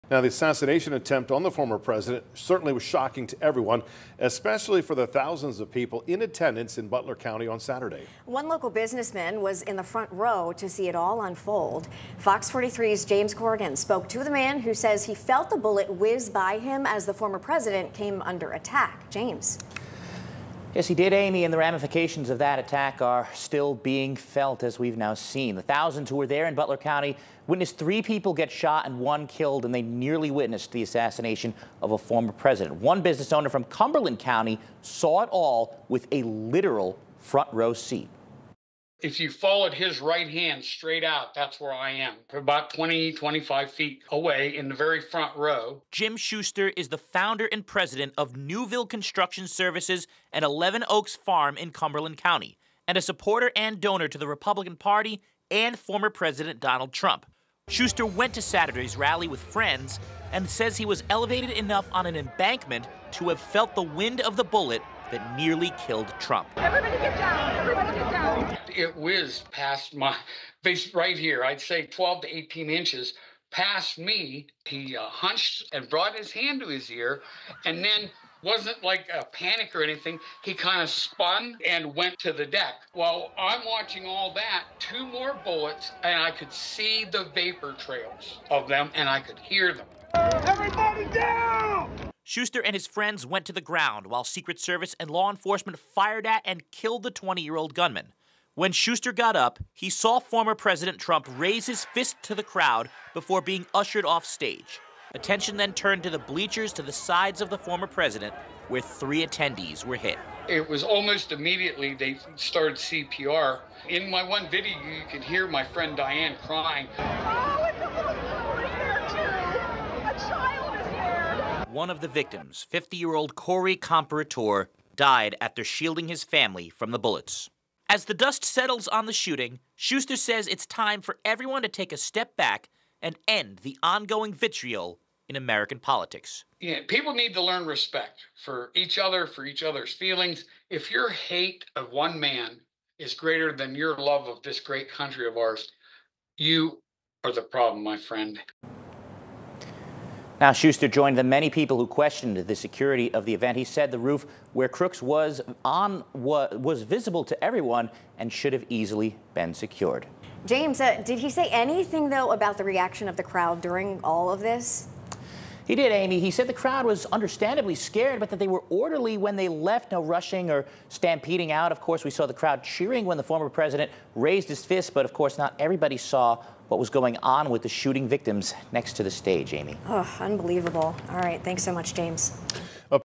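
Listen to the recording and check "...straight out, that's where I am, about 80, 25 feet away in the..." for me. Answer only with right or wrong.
wrong.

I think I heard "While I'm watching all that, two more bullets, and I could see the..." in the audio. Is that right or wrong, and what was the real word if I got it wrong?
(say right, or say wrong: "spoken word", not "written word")
right.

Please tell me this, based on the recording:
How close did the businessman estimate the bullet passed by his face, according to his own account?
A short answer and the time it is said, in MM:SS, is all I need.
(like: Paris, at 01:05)
12 to 18 inches, at 01:11.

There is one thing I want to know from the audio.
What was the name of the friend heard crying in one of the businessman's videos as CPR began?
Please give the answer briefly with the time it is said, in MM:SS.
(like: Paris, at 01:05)
Diane, at 01:55.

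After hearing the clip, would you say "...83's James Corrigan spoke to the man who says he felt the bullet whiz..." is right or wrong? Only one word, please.
wrong.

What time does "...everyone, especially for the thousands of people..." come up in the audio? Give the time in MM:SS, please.
00:03.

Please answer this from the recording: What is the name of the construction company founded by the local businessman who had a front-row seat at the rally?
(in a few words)
Newville Construction Services.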